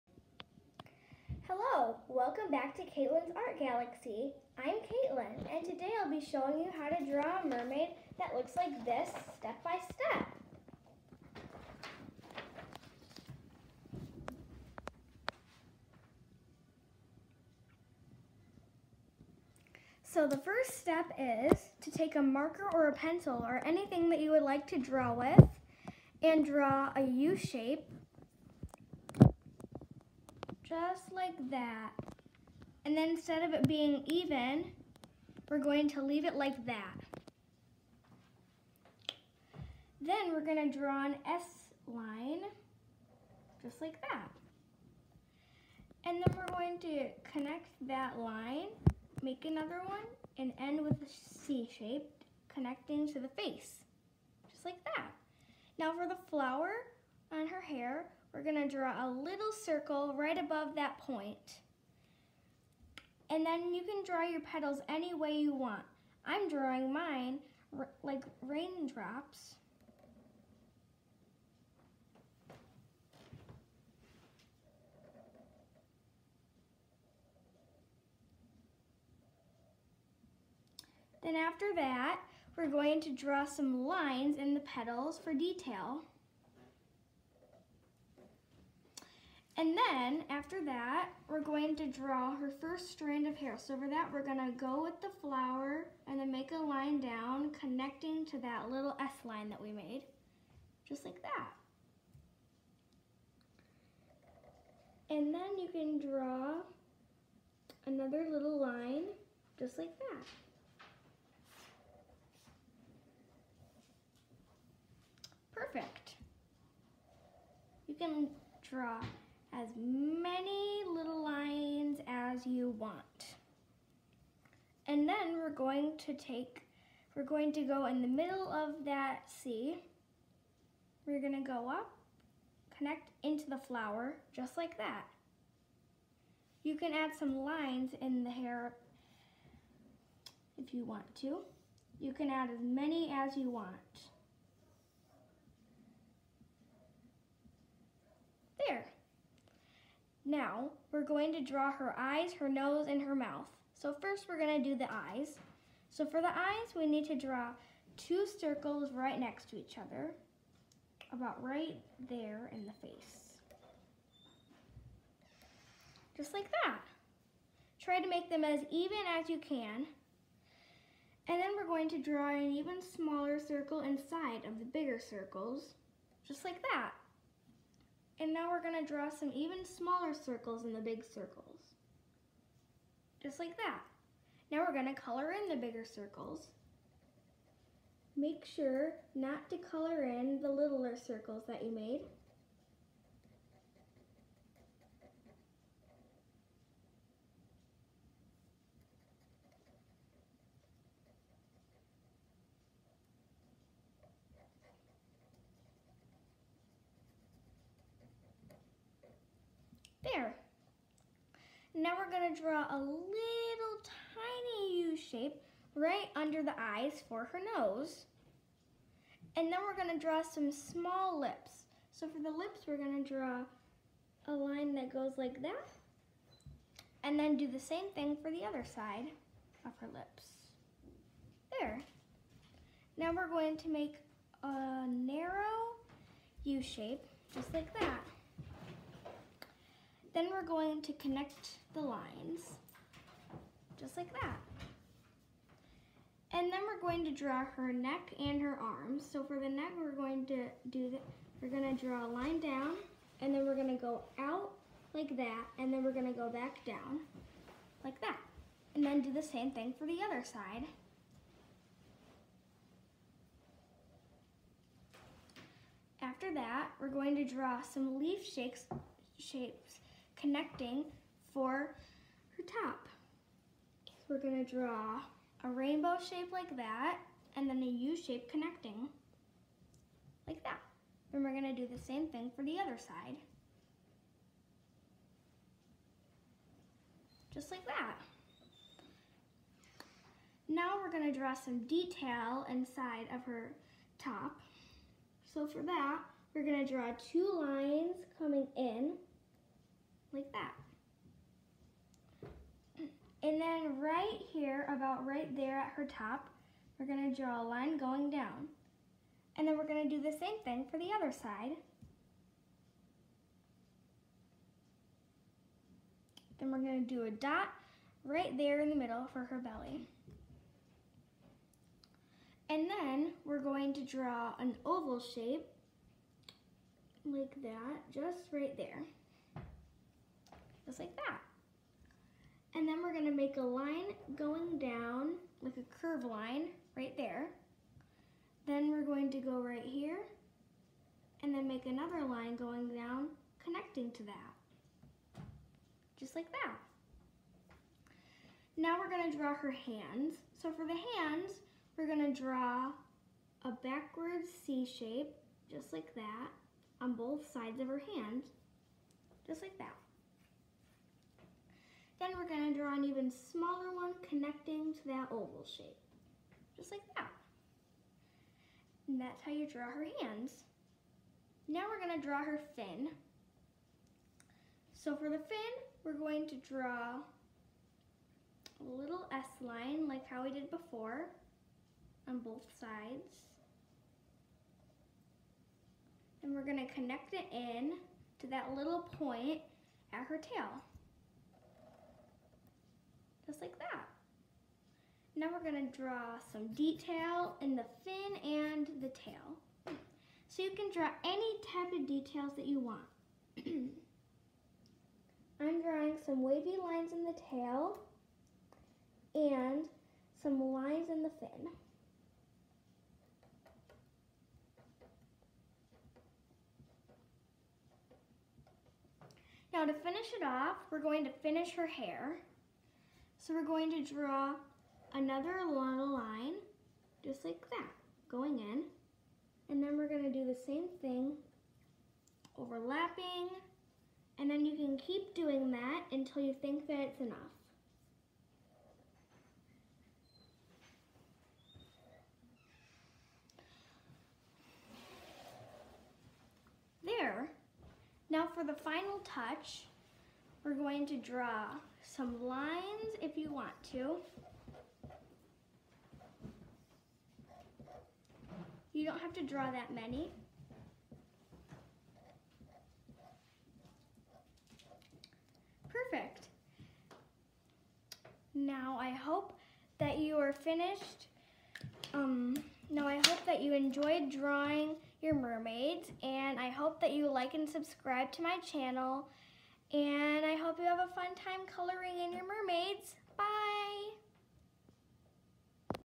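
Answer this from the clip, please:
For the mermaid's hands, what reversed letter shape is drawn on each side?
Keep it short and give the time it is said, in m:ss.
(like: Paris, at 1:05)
Backwards C shape, at 5:53.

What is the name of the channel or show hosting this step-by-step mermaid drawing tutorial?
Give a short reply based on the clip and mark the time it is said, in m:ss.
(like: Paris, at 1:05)
Katelyn's Art Galaxy, at 0:02.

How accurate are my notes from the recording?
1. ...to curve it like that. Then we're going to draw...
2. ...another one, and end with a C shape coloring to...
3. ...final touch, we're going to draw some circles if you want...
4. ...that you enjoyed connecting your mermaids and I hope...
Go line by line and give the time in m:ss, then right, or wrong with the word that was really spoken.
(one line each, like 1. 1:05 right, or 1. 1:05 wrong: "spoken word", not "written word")
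1. 0:35 wrong: "leave", not "curve"
2. 0:49 wrong: "connecting", not "coloring"
3. 7:28 wrong: "lines", not "circles"
4. 7:53 wrong: "drawing", not "connecting".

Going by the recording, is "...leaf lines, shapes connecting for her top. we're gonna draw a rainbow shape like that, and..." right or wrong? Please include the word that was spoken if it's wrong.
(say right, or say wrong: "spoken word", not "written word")
wrong: "shakes", not "lines".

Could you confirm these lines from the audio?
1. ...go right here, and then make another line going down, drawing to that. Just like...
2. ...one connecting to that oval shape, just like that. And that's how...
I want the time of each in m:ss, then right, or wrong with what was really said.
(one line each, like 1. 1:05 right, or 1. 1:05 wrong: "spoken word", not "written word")
1. 5:39 wrong: "connecting", not "drawing"
2. 6:03 right.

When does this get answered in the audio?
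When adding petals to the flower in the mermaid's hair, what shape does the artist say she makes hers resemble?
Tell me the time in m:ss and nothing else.
1:08.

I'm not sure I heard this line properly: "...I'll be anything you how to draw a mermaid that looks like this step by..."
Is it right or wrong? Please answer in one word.
wrong.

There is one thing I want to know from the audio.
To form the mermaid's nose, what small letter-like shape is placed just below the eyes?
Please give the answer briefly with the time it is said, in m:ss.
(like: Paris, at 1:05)
Tiny U shape, at 3:32.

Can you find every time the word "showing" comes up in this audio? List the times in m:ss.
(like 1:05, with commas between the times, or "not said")
0:06.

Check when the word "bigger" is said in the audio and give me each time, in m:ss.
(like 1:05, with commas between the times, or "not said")
2:54, 3:05.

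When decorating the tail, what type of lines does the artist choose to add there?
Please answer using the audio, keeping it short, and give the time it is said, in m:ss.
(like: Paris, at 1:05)
Wavy lines, at 6:46.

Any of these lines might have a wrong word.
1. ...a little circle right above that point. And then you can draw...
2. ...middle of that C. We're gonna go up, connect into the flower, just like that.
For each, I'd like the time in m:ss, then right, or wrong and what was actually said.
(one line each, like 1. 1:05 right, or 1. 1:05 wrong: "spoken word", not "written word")
1. 0:59 right
2. 2:08 right.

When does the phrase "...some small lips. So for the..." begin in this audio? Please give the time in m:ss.
3:40.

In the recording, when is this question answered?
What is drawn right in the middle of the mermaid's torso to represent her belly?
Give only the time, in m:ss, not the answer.
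5:17.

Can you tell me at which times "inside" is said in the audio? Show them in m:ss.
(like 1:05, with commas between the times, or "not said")
2:53, 4:52.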